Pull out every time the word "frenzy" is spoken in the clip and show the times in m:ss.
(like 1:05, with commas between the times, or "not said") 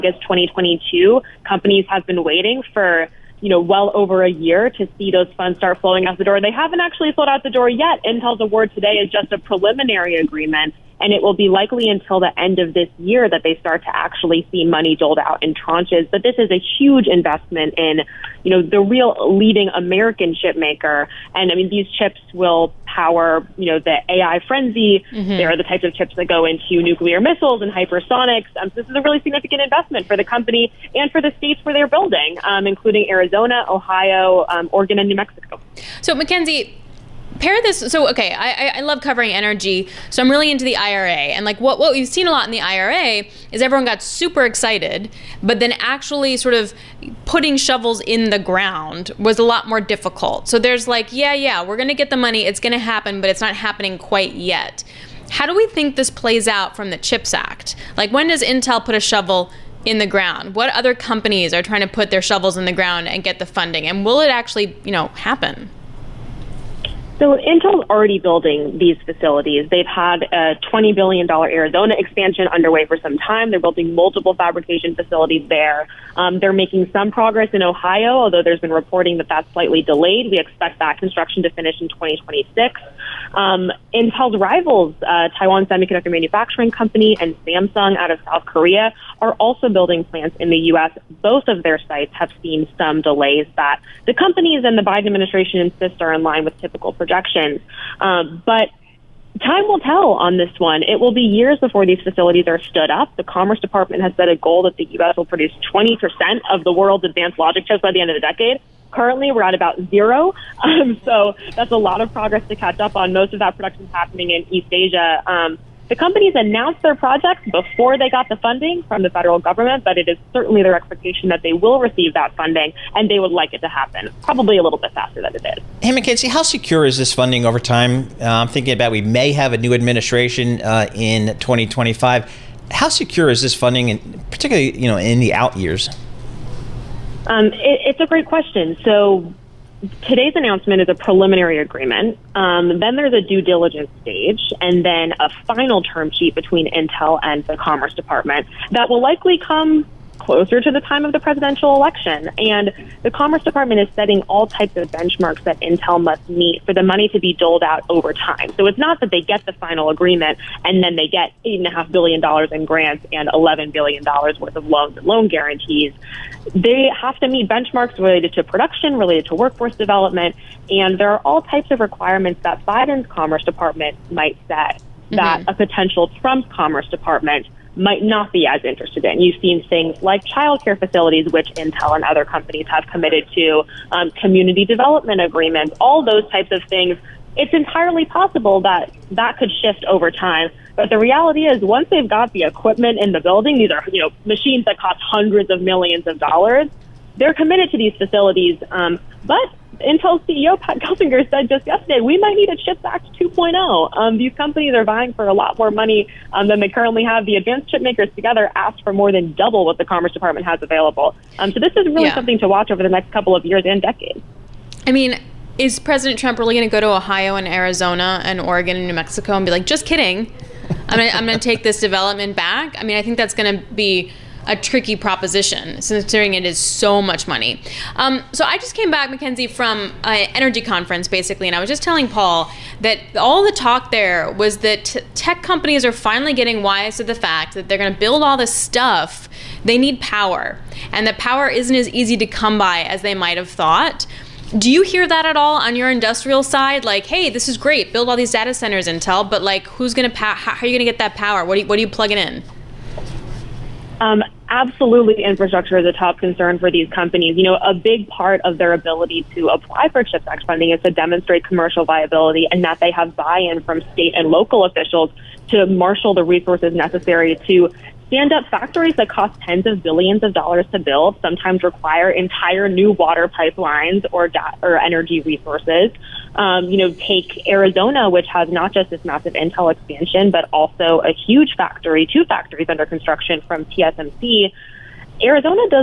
0:24.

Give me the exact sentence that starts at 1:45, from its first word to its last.
will produce 20% of the world's advanced logic chips by the end of the decade.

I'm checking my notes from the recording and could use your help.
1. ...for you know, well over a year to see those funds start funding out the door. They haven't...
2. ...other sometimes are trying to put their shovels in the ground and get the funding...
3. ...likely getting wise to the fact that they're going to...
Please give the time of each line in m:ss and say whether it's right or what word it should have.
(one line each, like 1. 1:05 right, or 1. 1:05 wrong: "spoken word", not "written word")
1. 0:02 wrong: "flowing", not "funding"
2. 1:00 wrong: "companies", not "sometimes"
3. 3:55 wrong: "finally", not "likely".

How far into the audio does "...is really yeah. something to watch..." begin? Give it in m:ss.
3:31.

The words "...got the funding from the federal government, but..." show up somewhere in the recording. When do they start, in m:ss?
1:58.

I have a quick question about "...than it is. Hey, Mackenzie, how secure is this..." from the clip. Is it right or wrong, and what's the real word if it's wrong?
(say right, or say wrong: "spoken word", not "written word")
right.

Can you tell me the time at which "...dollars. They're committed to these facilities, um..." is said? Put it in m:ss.
3:16.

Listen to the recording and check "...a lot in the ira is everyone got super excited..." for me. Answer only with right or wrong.
right.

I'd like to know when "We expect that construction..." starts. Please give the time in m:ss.
1:20.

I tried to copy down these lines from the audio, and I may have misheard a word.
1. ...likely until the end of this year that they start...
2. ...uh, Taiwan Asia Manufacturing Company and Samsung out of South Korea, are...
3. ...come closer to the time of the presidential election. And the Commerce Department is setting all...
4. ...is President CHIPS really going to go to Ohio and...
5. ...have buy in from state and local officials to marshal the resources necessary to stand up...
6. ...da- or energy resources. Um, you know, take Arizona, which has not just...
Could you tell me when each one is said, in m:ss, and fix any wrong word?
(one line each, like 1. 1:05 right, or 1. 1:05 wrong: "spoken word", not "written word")
1. 0:11 right
2. 1:25 wrong: "Semiconductor", not "Asia"
3. 2:29 right
4. 3:35 wrong: "Trump", not "CHIPS"
5. 4:22 right
6. 4:34 right.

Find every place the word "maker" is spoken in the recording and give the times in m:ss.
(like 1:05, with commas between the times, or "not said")
0:20, 3:27.